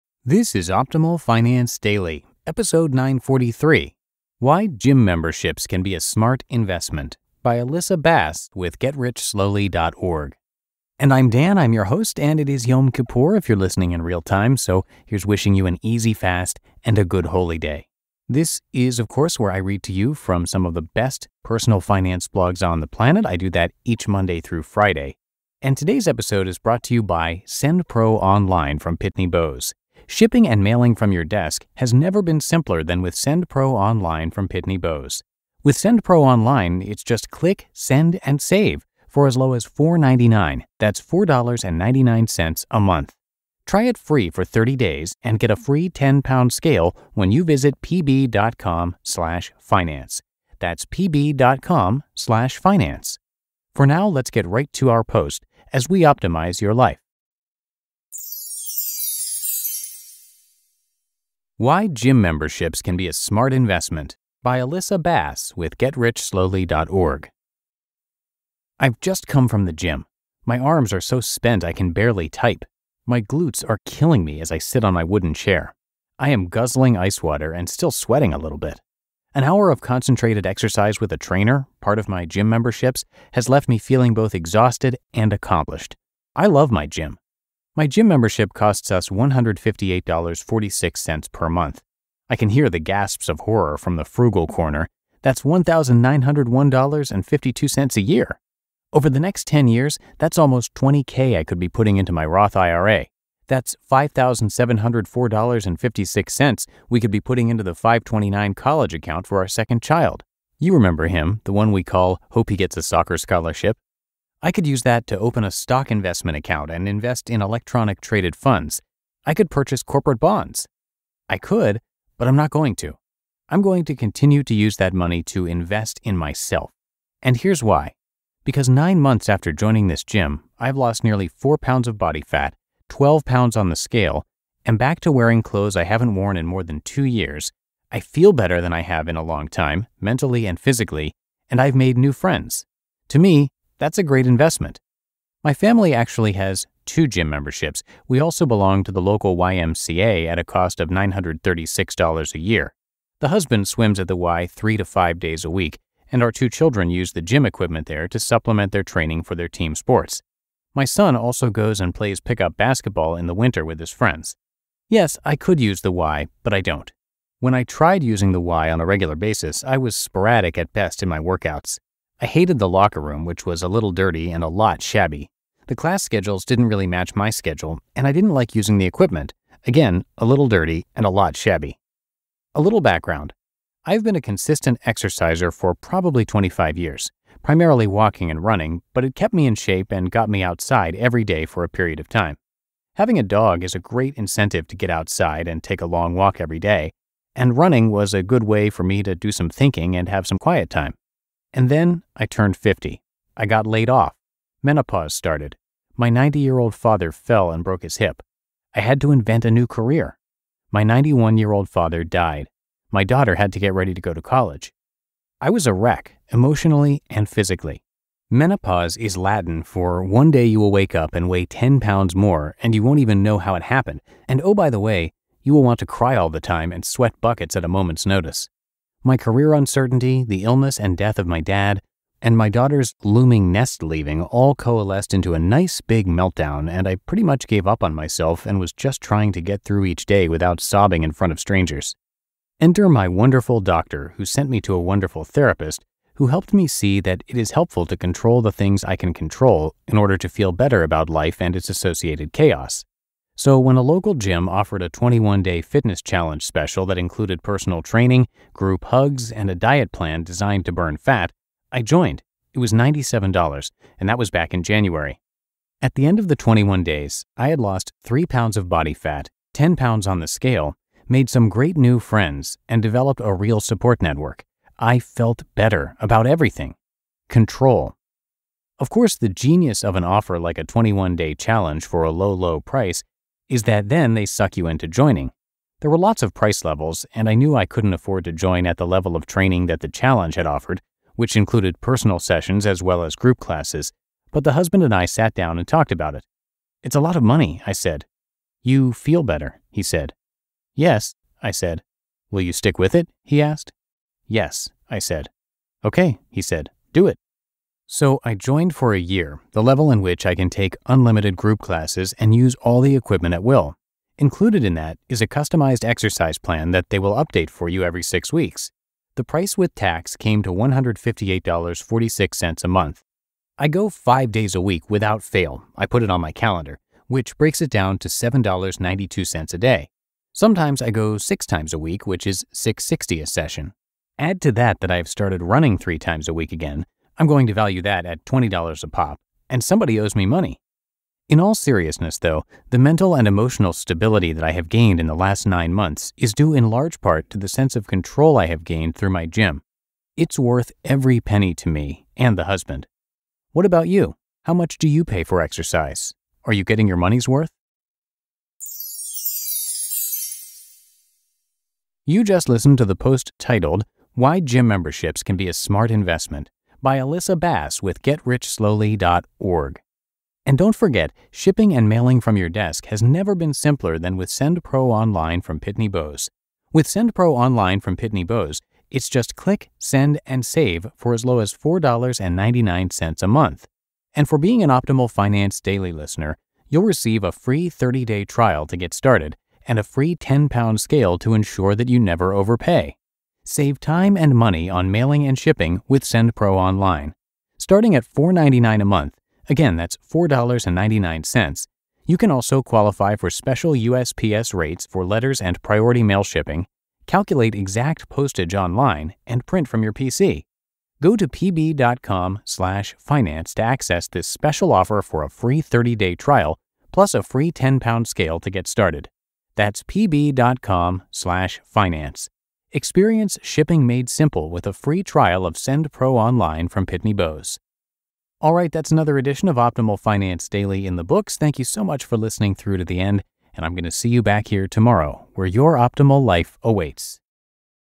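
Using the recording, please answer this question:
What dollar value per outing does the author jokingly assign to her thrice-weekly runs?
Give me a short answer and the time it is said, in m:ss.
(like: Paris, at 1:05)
$20, at 5:38.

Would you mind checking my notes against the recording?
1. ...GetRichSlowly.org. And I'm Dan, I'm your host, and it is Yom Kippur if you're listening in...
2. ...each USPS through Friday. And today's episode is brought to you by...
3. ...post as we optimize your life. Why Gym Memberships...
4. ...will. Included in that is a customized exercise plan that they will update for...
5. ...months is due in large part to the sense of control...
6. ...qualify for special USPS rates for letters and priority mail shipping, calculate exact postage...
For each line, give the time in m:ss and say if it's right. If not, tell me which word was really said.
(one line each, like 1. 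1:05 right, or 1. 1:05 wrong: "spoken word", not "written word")
1. 0:08 right
2. 0:23 wrong: "Monday", not "USPS"
3. 0:55 right
4. 5:13 right
5. 5:45 right
6. 6:42 right.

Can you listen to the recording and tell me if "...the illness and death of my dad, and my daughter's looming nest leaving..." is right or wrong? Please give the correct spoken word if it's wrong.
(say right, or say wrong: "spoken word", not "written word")
right.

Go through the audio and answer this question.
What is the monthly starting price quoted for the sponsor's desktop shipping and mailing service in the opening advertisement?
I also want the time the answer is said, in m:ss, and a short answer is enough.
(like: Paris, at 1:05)
$4.99, at 0:39.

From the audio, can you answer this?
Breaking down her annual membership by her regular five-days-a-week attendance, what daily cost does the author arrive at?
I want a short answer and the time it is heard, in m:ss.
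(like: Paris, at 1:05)
$7.92, at 5:28.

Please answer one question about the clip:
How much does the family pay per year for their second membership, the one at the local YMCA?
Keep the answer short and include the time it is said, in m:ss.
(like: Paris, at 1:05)
$936, at 2:30.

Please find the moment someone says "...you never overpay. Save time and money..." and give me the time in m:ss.
6:31.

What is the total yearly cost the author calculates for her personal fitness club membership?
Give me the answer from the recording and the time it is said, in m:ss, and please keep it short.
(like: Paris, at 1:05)
$1,901.52, at 1:35.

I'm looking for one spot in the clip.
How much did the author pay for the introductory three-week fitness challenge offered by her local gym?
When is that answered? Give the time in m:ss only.
4:22.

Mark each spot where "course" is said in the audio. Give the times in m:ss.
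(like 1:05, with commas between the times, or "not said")
0:19, 4:38.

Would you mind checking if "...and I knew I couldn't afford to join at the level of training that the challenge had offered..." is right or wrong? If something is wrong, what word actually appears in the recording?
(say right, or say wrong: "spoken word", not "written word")
right.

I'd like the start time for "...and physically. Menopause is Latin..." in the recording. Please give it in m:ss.
3:37.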